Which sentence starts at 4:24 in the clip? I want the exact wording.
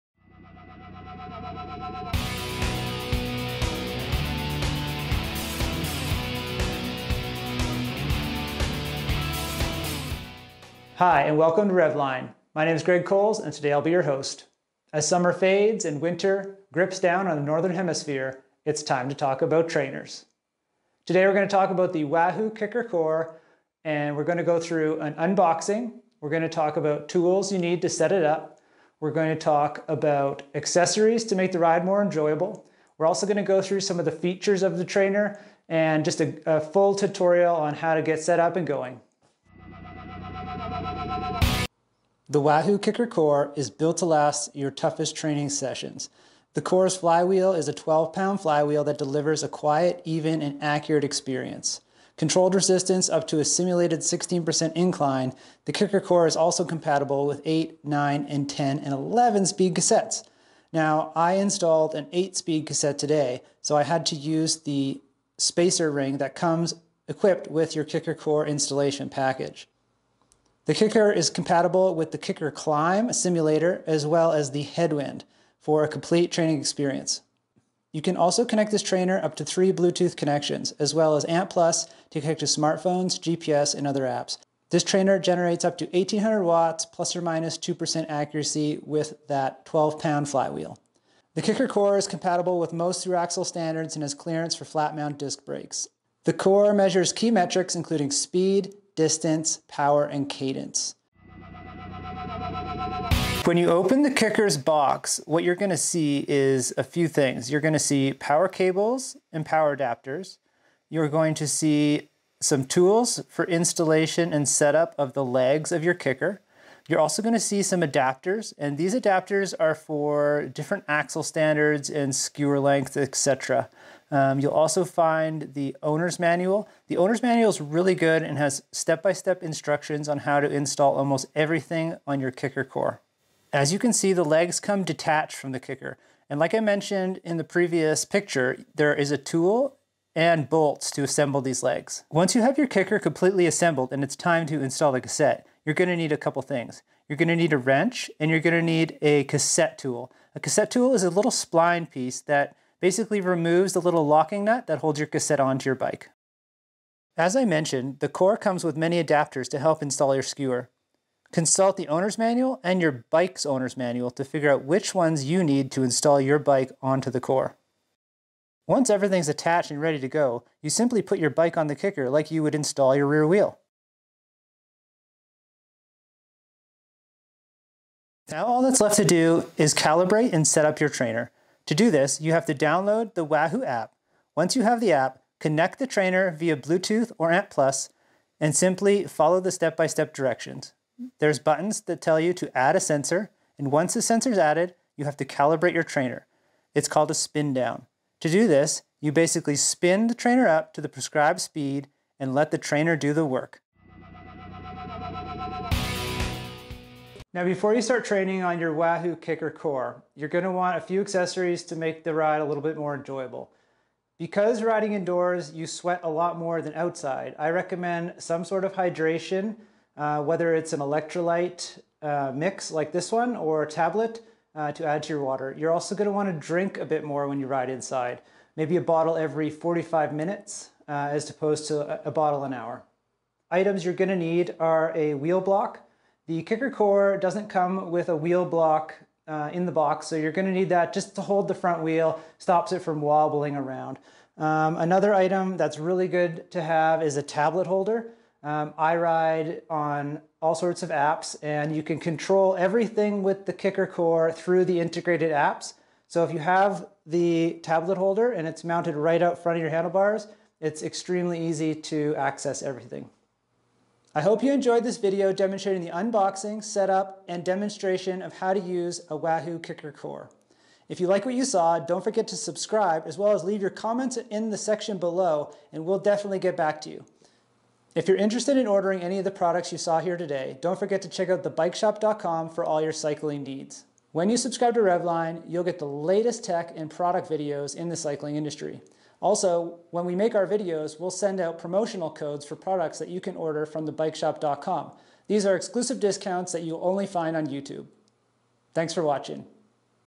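I hope you enjoyed this video demonstrating the unboxing, setup, and demonstration of how to use a Wahoo Kickr Core.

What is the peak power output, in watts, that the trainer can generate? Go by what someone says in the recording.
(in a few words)
1800 watts.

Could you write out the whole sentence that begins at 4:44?
When you subscribe to Revline, you'll get the latest tech and product videos in the cycling industry.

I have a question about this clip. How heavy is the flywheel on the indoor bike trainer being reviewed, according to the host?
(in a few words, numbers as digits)
12 pounds.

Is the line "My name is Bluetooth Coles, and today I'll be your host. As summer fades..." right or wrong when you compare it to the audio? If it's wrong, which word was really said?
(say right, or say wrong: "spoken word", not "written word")
wrong: "Greg", not "Bluetooth".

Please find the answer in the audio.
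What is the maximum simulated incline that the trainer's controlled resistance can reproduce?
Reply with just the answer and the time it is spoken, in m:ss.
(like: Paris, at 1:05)
16%, at 0:53.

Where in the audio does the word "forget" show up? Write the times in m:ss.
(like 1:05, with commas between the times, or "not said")
4:32, 4:40.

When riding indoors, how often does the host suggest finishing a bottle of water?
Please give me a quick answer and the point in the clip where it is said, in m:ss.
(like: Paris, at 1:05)
every 45 minutes, at 3:49.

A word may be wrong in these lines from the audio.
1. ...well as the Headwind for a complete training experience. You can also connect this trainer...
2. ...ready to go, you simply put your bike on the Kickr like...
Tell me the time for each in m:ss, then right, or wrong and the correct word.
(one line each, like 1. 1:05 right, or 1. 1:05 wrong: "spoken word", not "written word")
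1. 1:14 right
2. 2:49 right.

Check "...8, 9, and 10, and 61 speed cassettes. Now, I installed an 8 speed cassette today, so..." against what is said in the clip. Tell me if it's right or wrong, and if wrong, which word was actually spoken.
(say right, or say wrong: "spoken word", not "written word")
wrong: "11", not "61".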